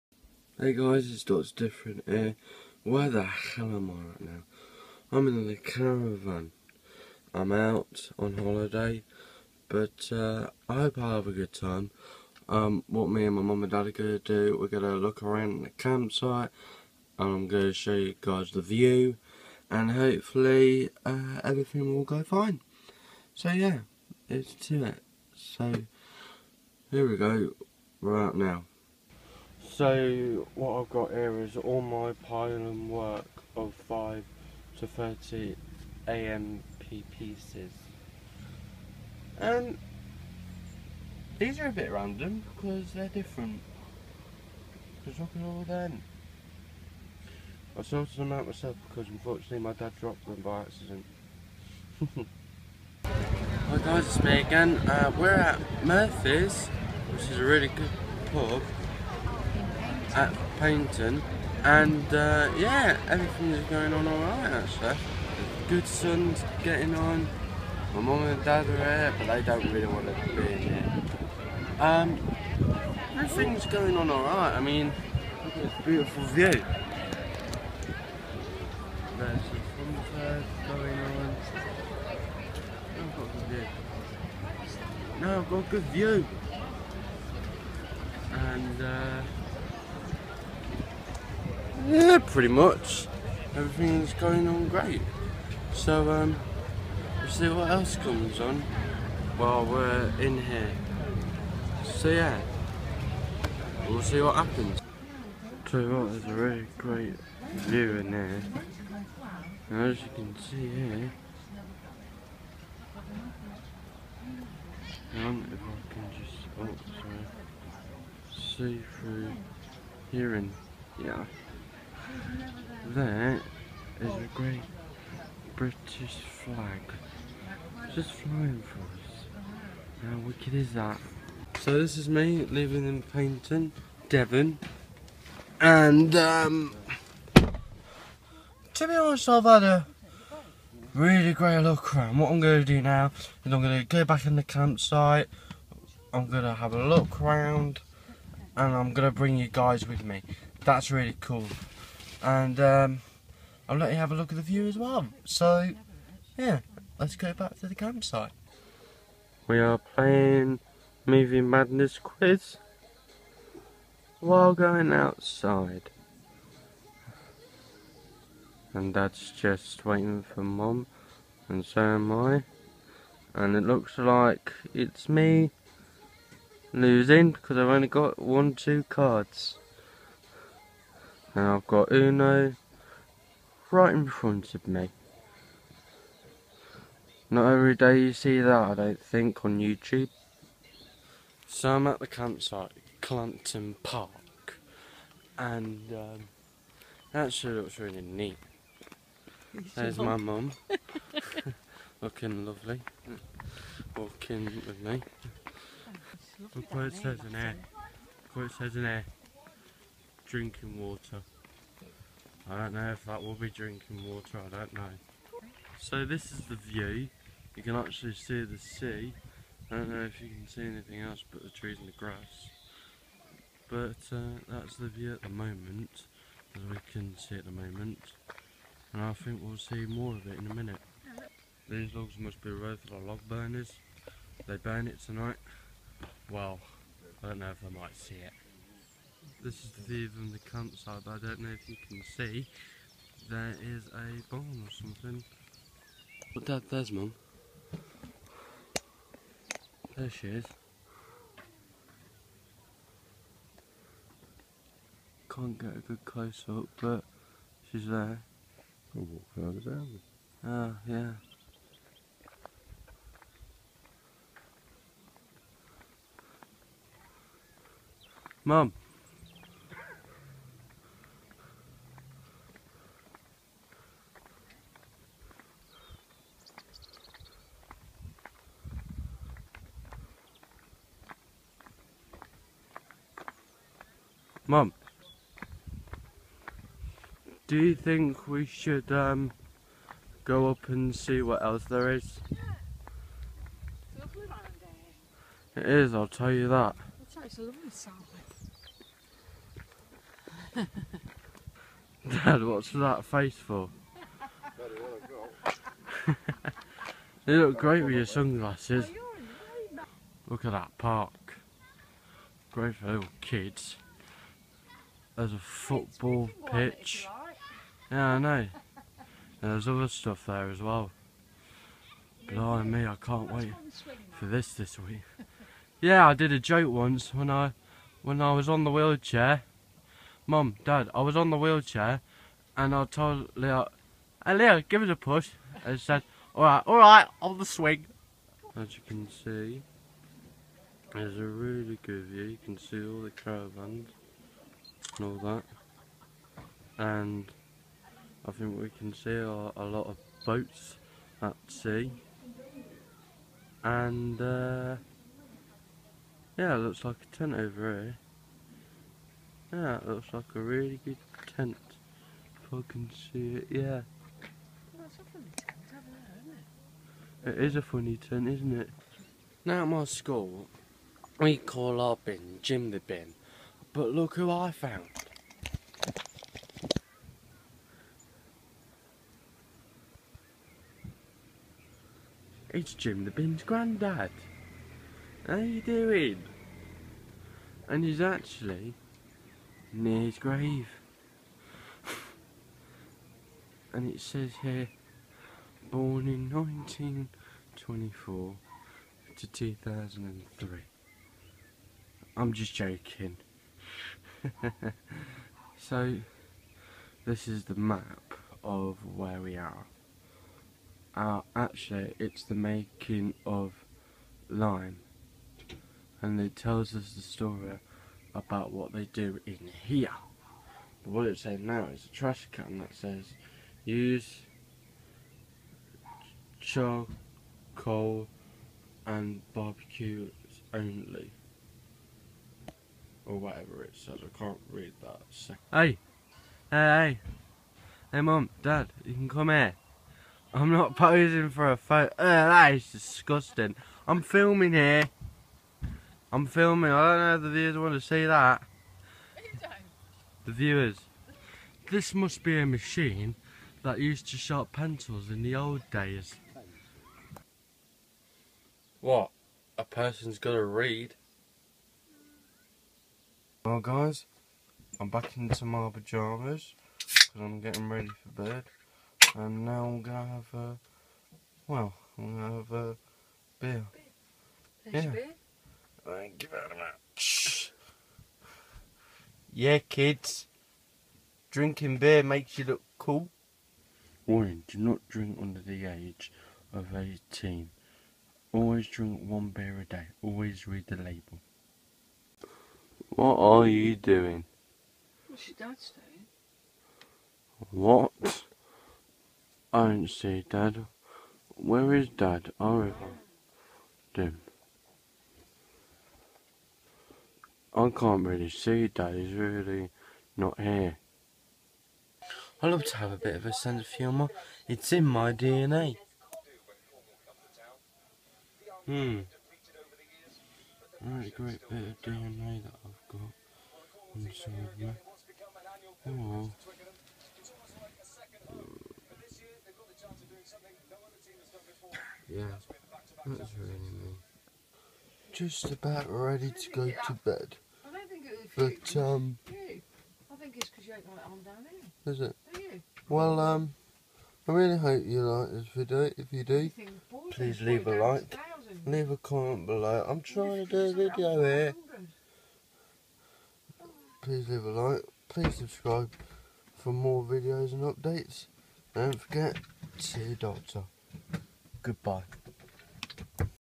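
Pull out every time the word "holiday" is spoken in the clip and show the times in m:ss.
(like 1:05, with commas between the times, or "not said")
0:08.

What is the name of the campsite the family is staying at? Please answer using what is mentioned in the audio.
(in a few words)
Galmpton Park.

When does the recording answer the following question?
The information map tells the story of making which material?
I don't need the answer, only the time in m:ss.
6:54.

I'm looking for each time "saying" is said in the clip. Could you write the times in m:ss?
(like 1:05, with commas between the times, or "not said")
7:01, 8:15.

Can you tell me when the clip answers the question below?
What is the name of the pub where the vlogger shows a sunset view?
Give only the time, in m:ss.
0:55.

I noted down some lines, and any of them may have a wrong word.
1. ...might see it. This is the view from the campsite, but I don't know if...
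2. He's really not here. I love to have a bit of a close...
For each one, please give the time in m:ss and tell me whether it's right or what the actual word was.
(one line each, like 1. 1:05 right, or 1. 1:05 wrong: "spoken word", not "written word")
1. 3:57 right
2. 8:28 wrong: "sense", not "close".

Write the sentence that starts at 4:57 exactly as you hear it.
It's a lovely Dad, what's that face for?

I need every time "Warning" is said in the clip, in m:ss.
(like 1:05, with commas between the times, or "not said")
8:04.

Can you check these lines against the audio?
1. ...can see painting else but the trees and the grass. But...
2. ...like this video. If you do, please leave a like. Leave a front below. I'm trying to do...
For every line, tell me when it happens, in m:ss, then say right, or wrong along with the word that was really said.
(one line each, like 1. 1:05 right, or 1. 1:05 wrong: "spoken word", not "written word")
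1. 3:40 wrong: "anything", not "painting"
2. 9:05 wrong: "comment", not "front".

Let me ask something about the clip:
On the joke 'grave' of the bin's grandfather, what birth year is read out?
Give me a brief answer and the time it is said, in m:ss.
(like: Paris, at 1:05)
1924, at 6:36.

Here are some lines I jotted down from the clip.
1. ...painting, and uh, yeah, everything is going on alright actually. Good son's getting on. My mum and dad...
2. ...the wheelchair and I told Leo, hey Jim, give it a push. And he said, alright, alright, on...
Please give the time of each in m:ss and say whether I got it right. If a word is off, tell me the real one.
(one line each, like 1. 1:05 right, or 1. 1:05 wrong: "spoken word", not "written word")
1. 1:00 right
2. 5:31 wrong: "Leo", not "Jim".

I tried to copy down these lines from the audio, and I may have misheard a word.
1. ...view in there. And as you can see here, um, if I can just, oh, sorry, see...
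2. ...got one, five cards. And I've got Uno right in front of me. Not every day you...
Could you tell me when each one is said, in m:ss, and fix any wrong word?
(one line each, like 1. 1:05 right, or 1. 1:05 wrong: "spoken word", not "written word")
1. 1:47 right
2. 2:57 wrong: "two", not "five".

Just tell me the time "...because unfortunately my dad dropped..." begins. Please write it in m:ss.
0:48.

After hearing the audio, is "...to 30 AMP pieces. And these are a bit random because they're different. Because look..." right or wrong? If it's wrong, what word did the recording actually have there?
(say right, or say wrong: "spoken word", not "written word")
right.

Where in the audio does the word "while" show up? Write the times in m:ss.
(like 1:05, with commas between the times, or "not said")
1:39, 2:44.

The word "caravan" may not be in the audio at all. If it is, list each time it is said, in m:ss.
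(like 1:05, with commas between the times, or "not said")
0:05, 5:43.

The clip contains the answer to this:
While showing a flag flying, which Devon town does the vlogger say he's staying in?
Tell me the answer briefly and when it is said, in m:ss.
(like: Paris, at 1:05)
Paignton, at 2:13.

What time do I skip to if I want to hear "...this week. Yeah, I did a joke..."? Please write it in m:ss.
5:24.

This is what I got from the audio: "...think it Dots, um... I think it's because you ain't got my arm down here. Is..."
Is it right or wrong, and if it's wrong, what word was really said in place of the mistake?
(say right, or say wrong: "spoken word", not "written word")
wrong: "But", not "Dots".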